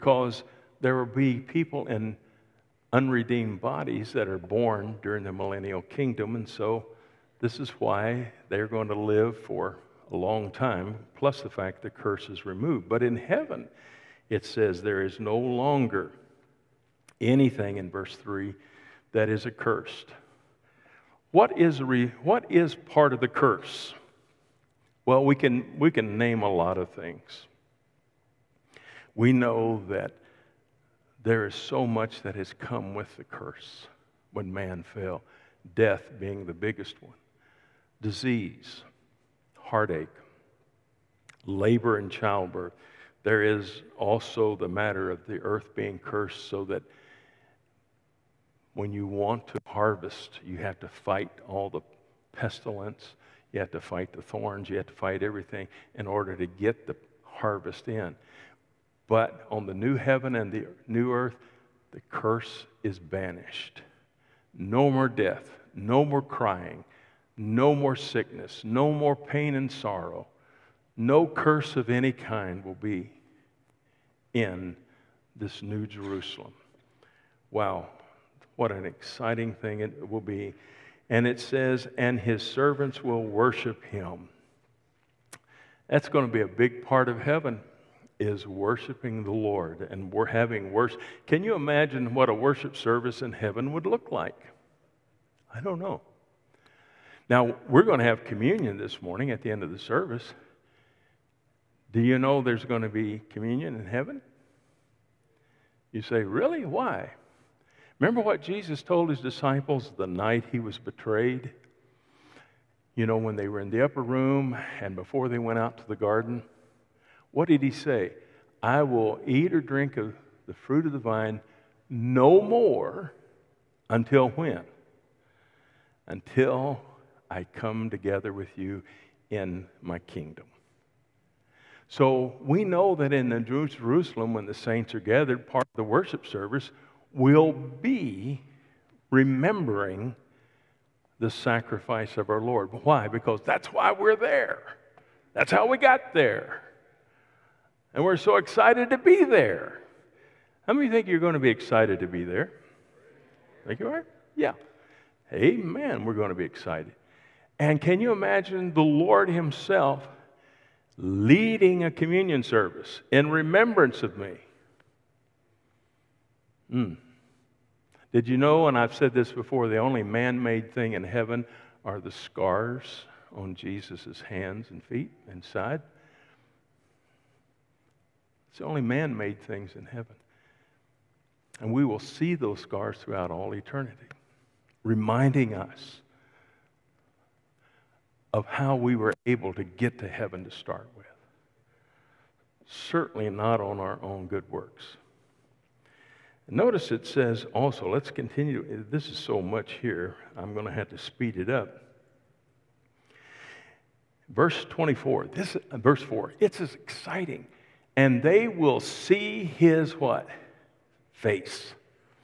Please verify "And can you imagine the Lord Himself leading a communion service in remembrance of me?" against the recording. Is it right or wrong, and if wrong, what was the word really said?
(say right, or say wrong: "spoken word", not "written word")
right.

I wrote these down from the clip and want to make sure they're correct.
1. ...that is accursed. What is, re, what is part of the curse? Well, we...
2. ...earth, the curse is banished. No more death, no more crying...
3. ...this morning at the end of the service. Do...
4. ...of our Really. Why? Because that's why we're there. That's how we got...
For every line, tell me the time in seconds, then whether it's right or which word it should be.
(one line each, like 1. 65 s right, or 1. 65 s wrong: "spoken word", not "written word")
1. 19 s right
2. 61 s right
3. 98 s right
4. 142 s wrong: "Lord", not "Really".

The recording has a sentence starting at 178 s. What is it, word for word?
It's the only man made things in heaven.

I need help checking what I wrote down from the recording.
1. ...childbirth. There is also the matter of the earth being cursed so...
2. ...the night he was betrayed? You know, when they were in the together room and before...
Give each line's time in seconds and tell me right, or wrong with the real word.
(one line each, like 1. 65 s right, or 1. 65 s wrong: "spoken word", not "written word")
1. 42 s right
2. 109 s wrong: "upper", not "together".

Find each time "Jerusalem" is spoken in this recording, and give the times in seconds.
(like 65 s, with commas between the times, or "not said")
75 s, 133 s.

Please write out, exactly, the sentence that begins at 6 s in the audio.
And so this is why they're going to live for a long time, plus the fact the curse is removed.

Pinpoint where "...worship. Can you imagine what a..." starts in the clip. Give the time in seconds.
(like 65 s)
90 s.